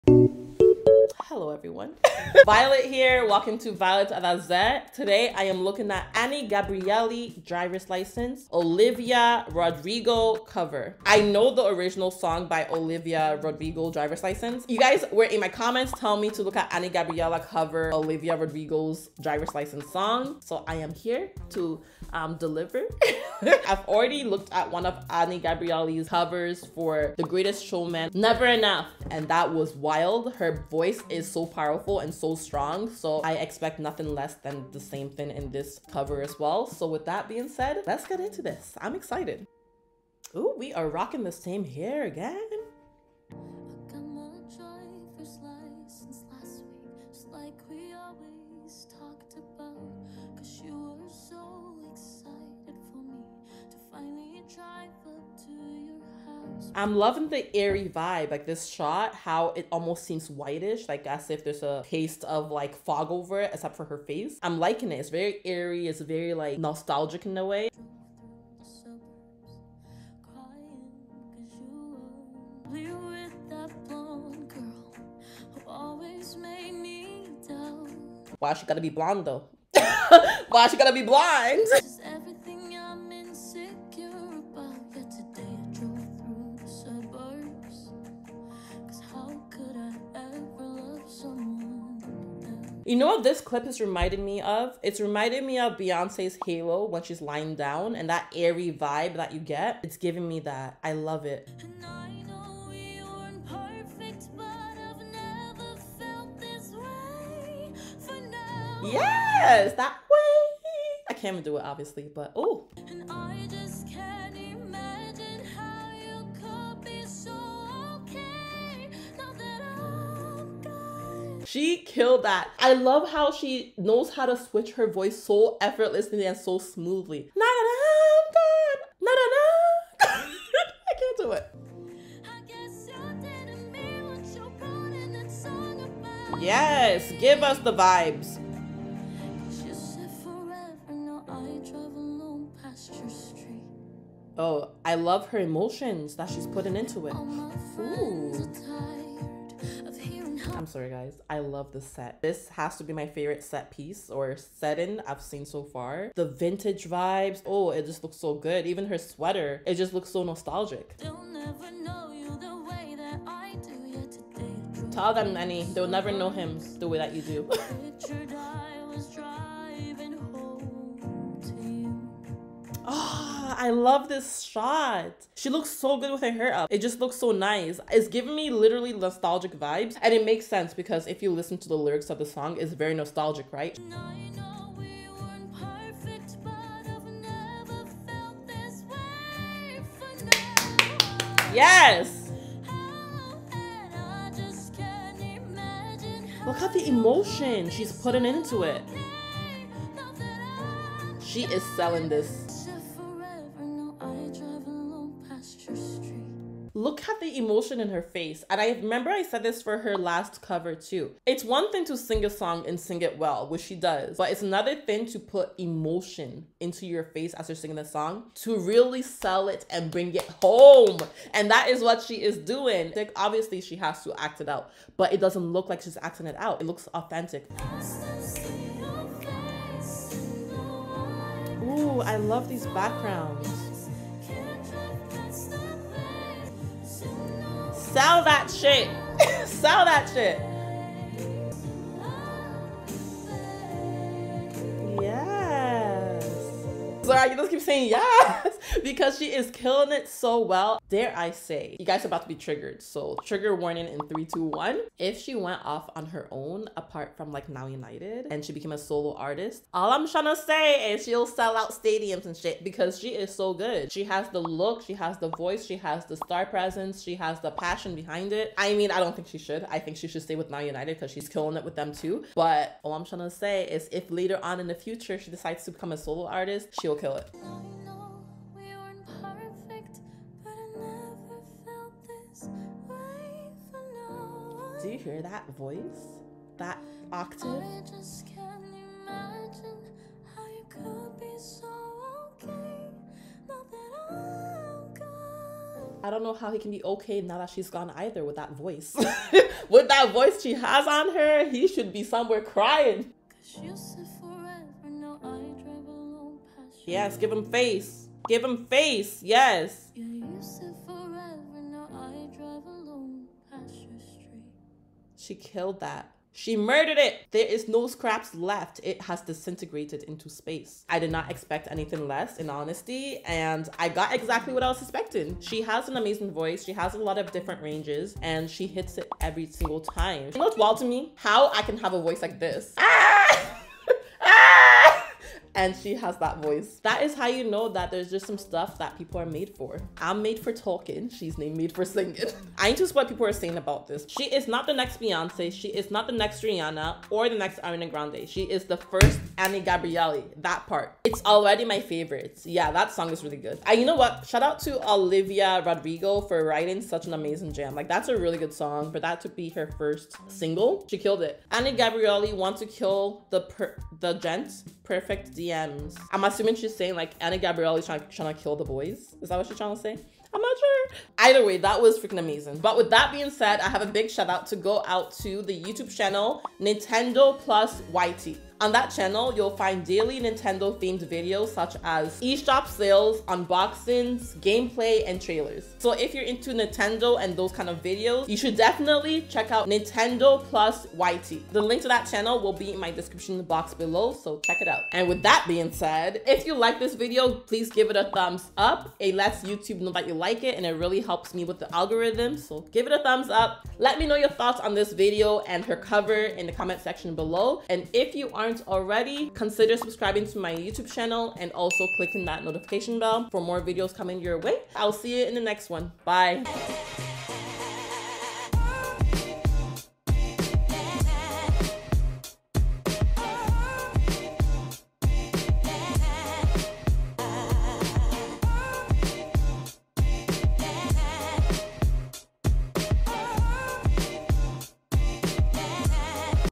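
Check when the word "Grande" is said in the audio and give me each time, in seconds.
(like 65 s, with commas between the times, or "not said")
347 s.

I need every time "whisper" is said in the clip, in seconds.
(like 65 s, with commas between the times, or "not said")
not said.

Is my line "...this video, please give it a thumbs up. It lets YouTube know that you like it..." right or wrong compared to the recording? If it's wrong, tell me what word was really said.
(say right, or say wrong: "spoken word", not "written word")
right.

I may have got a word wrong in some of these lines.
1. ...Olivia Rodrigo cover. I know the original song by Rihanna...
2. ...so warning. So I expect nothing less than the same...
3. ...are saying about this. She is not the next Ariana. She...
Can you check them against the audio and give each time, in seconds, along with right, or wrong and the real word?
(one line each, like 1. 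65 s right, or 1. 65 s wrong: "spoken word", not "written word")
1. 8 s wrong: "Olivia", not "Rihanna"
2. 32 s wrong: "strong", not "warning"
3. 343 s wrong: "Beyonce", not "Ariana".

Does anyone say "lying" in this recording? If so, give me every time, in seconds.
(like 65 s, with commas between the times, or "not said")
97 s.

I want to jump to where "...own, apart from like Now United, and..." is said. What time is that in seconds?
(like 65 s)
256 s.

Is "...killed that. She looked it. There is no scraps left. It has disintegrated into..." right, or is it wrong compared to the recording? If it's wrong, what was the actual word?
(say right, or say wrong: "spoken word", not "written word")
wrong: "murdered", not "looked".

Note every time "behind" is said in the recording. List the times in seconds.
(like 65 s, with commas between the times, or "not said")
267 s.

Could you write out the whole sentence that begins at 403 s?
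Let me know your thoughts on this video and her cover in the comment section below.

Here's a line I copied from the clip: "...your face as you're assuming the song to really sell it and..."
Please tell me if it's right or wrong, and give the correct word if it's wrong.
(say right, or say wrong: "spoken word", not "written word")
wrong: "singing", not "assuming".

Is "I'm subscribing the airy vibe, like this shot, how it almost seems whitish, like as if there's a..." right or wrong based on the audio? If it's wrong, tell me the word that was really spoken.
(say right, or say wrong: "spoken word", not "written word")
wrong: "loving", not "subscribing".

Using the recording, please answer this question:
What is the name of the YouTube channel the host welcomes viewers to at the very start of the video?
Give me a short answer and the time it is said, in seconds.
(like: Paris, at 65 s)
Violet Adazé, at 3 s.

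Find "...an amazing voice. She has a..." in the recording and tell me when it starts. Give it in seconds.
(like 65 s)
325 s.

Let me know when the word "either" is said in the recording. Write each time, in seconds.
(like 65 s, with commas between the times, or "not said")
297 s, 371 s.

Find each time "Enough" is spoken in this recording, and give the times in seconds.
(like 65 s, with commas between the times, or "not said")
28 s.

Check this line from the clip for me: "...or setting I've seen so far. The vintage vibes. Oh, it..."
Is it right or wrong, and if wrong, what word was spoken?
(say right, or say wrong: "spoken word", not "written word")
right.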